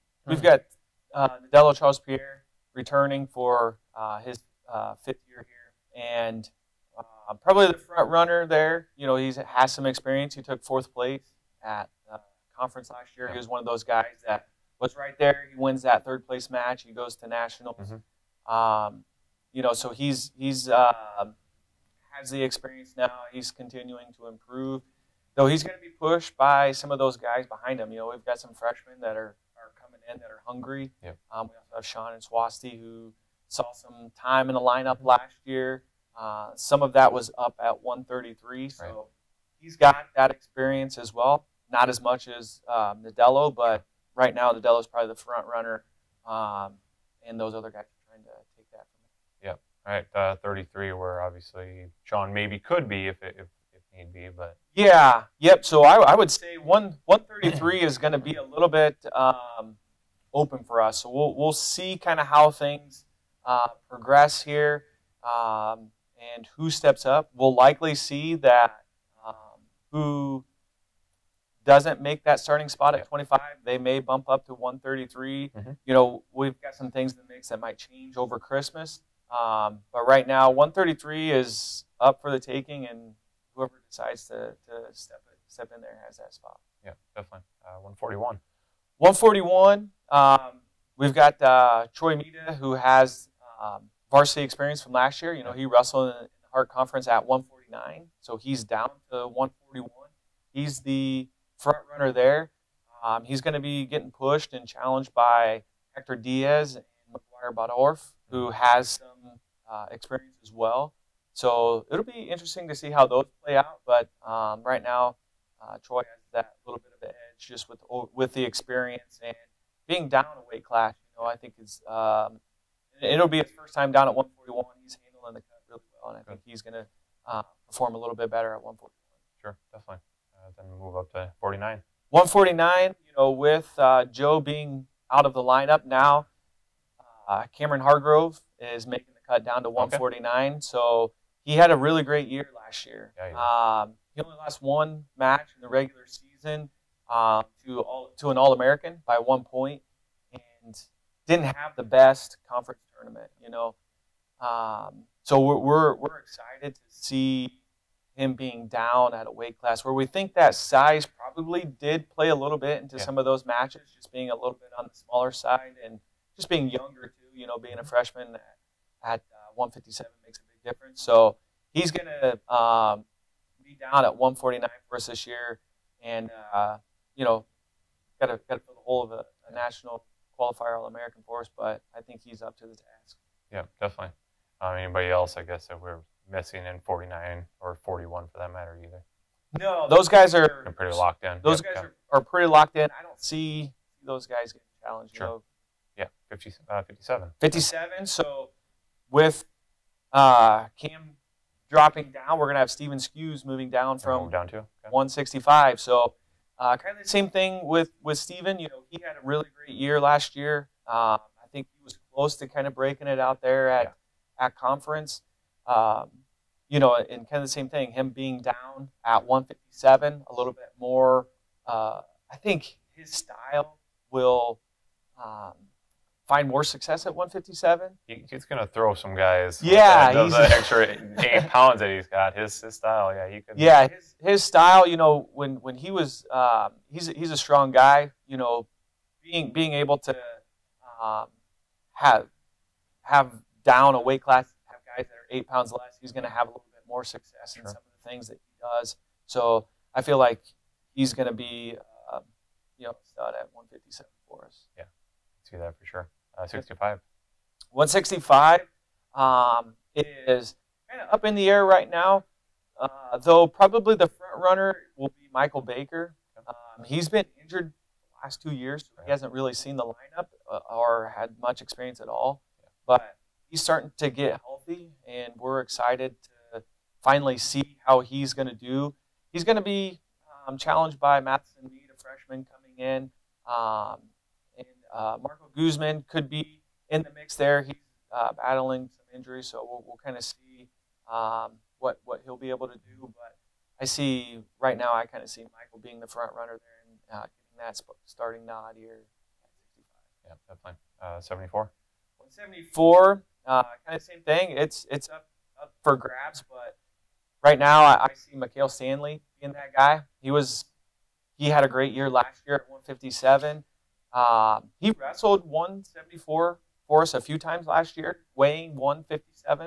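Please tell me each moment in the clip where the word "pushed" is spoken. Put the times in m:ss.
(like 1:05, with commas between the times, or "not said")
0:26, 1:44.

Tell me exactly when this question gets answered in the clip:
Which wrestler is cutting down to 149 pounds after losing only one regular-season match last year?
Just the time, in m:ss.
2:17.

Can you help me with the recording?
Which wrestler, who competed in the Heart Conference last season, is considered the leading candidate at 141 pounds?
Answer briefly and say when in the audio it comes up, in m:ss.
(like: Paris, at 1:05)
Troy Mita, at 1:31.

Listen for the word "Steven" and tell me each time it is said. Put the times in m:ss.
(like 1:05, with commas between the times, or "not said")
3:22, 3:28.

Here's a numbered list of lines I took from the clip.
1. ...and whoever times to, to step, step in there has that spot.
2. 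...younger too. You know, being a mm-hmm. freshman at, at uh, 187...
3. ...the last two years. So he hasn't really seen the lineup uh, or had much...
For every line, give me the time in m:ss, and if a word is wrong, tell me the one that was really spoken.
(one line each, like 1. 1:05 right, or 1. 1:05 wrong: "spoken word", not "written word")
1. 1:22 wrong: "decides", not "times"
2. 2:46 wrong: "157", not "187"
3. 4:28 right.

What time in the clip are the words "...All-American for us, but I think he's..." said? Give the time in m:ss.
3:00.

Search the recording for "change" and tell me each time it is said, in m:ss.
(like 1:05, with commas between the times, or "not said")
1:17.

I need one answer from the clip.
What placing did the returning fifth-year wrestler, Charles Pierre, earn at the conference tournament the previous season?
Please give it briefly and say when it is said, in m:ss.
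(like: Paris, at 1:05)
Fourth place, at 0:10.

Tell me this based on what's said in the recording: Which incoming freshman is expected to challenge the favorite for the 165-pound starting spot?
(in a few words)
Matheson Mead.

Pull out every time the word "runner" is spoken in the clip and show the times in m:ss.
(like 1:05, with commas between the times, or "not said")
0:08, 0:45, 1:41, 4:24, 4:56.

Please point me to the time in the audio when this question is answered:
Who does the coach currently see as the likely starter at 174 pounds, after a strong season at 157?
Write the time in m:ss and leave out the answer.
5:08.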